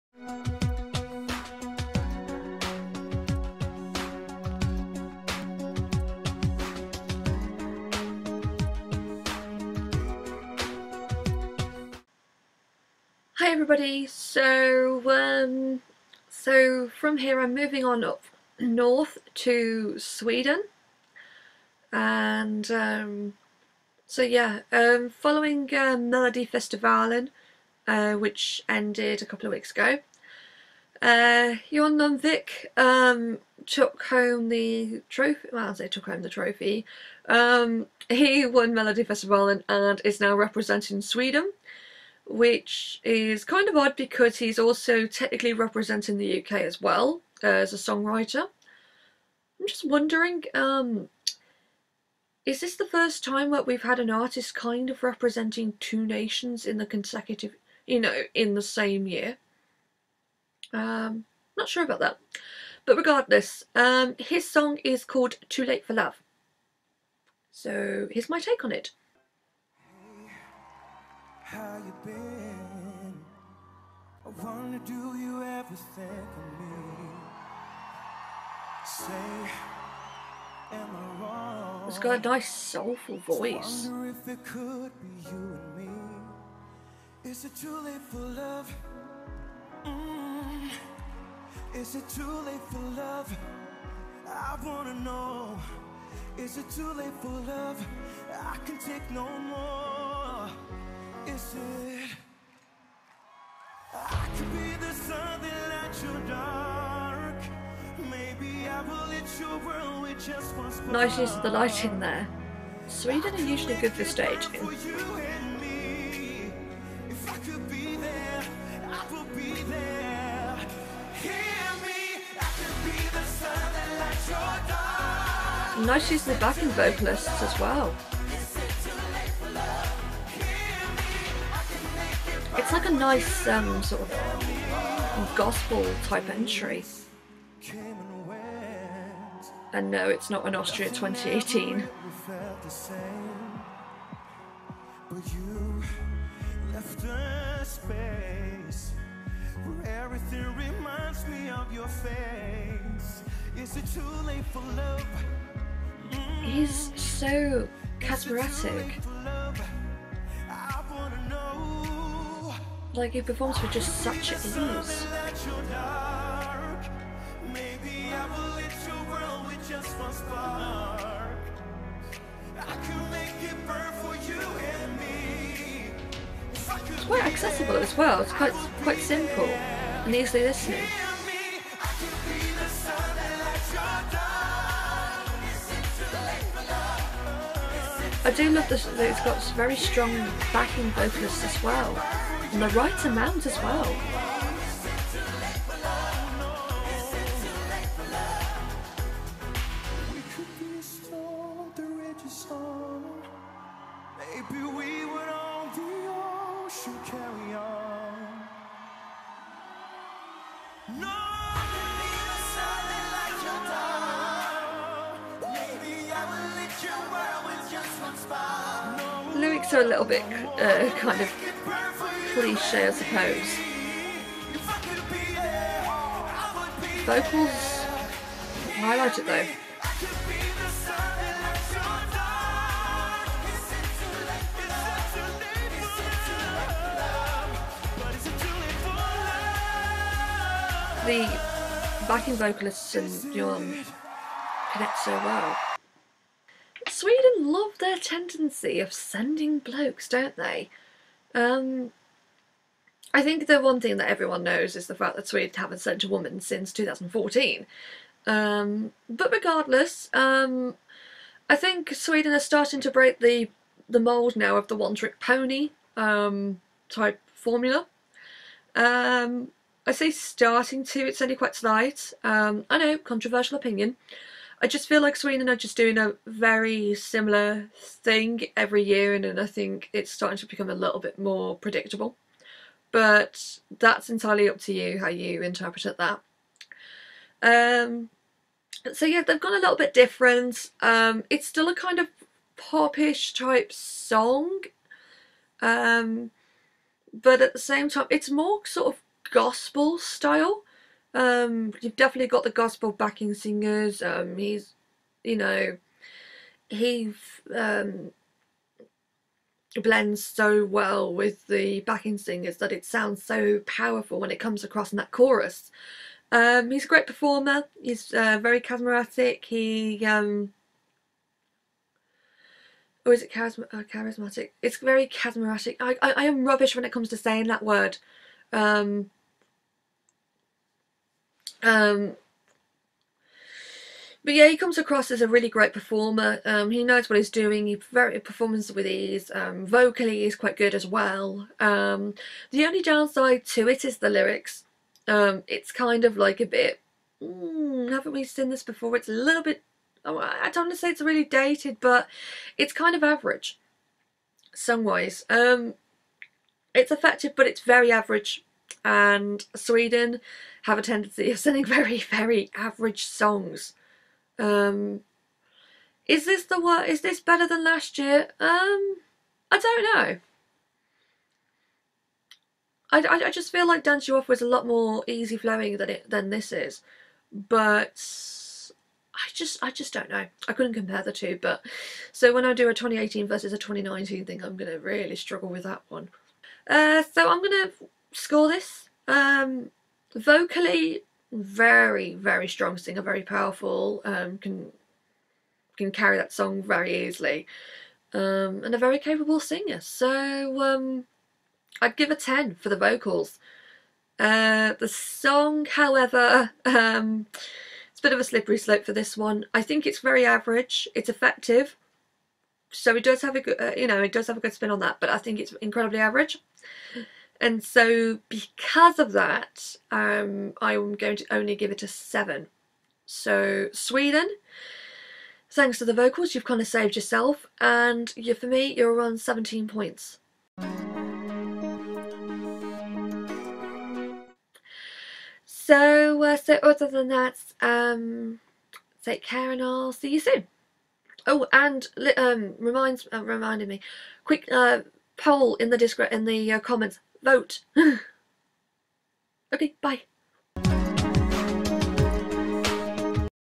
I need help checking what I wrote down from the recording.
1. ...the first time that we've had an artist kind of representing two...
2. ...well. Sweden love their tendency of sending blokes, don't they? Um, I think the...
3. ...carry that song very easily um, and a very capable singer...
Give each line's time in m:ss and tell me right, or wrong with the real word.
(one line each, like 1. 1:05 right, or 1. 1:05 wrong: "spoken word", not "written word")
1. 0:52 right
2. 4:05 right
3. 6:35 right.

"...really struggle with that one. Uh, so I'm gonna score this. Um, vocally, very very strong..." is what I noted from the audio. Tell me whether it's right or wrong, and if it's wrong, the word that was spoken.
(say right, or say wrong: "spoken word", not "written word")
right.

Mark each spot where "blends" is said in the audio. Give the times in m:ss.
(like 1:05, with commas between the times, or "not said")
5:09.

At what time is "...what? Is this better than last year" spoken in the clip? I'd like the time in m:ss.
6:06.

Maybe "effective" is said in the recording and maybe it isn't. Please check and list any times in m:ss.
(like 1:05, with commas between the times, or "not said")
5:56, 6:51.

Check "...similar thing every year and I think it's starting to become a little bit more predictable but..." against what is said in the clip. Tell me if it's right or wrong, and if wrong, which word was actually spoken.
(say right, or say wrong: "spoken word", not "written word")
right.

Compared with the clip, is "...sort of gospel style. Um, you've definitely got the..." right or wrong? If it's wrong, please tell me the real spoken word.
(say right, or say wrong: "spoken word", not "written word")
right.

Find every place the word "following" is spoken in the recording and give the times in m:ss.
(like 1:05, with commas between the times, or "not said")
0:25.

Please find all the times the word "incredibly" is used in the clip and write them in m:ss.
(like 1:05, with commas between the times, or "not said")
6:55.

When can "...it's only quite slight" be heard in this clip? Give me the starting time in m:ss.
4:31.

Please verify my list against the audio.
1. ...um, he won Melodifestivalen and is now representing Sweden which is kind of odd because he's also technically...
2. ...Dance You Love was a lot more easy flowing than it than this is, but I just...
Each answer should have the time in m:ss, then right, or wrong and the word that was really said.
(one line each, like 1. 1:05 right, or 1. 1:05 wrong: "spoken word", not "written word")
1. 0:37 right
2. 6:13 wrong: "Off", not "Love".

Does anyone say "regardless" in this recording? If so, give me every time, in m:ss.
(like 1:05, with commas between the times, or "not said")
1:02, 4:19.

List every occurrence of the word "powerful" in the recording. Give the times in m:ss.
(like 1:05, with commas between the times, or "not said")
5:13, 6:33.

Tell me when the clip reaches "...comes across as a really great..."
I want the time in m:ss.
5:34.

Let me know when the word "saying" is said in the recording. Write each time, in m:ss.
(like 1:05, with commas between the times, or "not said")
5:27.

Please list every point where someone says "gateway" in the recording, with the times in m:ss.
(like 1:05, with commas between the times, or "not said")
not said.